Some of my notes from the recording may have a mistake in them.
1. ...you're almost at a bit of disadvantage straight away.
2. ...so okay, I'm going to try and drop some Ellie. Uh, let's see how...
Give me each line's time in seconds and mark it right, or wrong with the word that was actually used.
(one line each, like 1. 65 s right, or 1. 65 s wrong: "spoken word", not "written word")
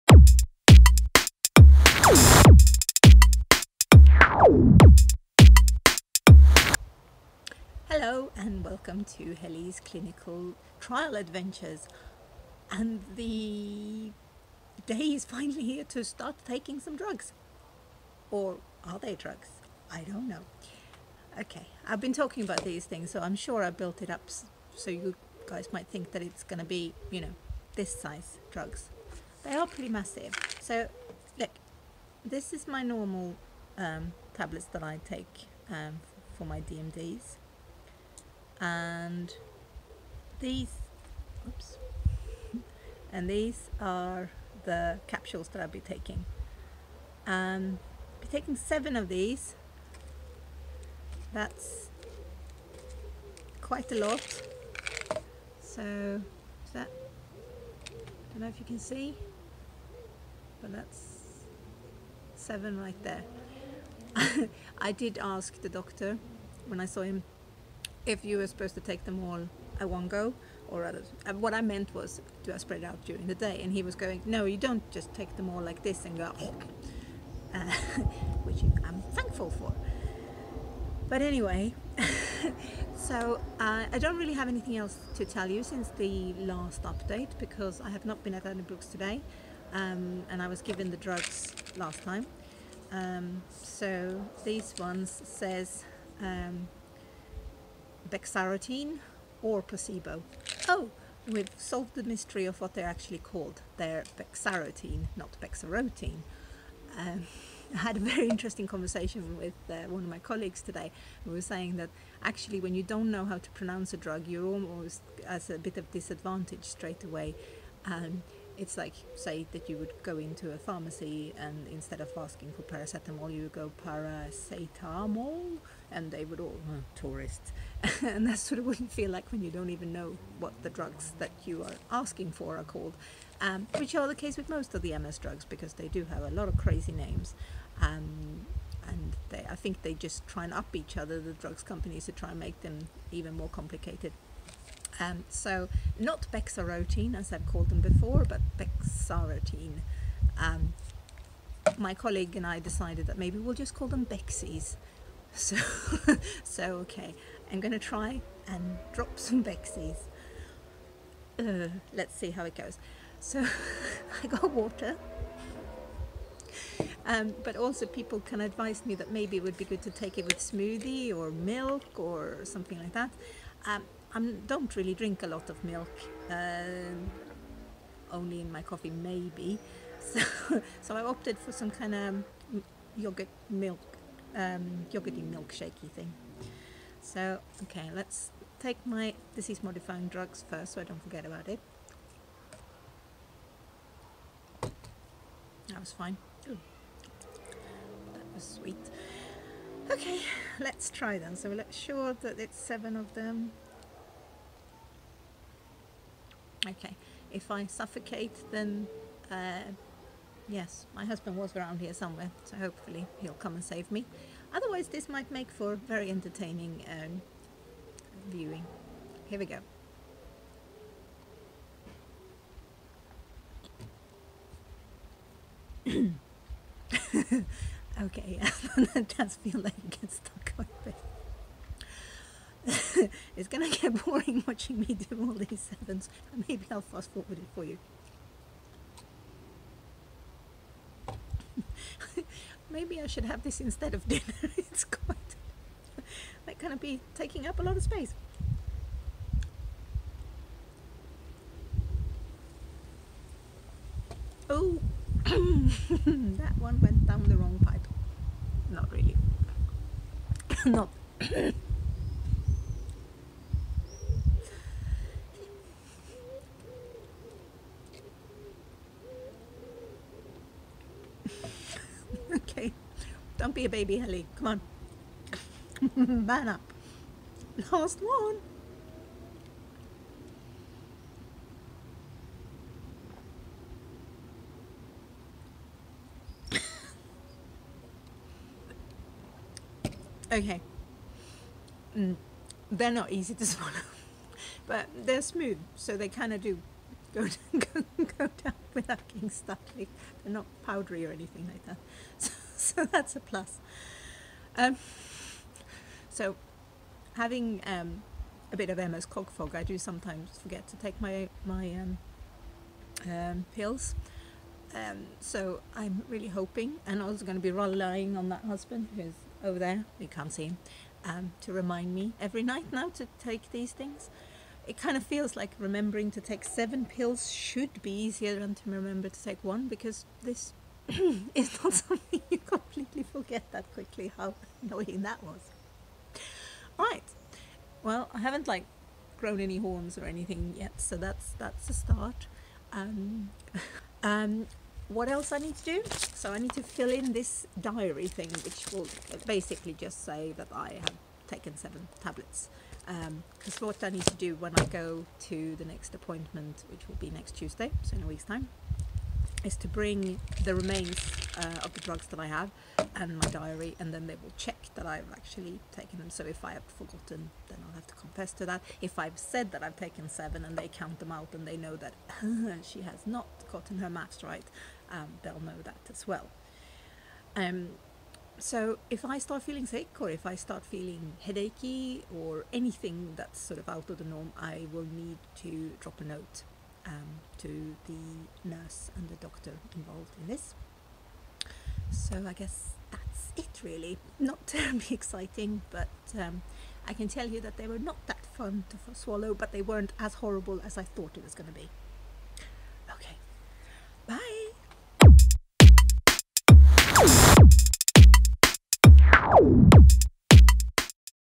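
1. 114 s right
2. 156 s wrong: "Bexies", not "Ellie".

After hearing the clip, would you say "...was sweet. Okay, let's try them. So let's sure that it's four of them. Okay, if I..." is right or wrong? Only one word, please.
wrong.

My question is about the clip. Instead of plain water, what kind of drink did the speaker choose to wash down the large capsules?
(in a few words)
yogurt milk.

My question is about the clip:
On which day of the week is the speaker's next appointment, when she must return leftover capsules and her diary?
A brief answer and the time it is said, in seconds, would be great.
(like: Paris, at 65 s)
Tuesday, at 357 s.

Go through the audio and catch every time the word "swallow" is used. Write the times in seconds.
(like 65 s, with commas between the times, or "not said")
293 s, 398 s.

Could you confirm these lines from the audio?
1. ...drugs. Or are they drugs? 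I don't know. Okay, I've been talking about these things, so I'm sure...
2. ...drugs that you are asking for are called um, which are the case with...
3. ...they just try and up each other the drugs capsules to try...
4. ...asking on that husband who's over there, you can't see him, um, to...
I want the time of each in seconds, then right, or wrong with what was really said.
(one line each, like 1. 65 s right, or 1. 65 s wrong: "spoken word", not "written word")
1. 16 s right
2. 130 s right
3. 139 s wrong: "companies", not "capsules"
4. 317 s wrong: "relying", not "asking".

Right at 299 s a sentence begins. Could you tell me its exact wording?
They're not powdery or anything like that.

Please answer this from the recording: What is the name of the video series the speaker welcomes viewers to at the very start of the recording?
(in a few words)
Hellie's Clinical Trial Adventures.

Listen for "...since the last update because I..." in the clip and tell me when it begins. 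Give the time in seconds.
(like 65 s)
85 s.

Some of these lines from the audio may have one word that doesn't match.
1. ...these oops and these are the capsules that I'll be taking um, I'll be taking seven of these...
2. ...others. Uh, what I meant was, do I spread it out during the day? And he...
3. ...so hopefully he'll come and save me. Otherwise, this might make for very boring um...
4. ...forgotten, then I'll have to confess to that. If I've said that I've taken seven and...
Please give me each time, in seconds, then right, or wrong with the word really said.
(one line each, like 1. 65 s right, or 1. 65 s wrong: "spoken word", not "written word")
1. 40 s right
2. 70 s right
3. 212 s wrong: "entertaining", not "boring"
4. 366 s right.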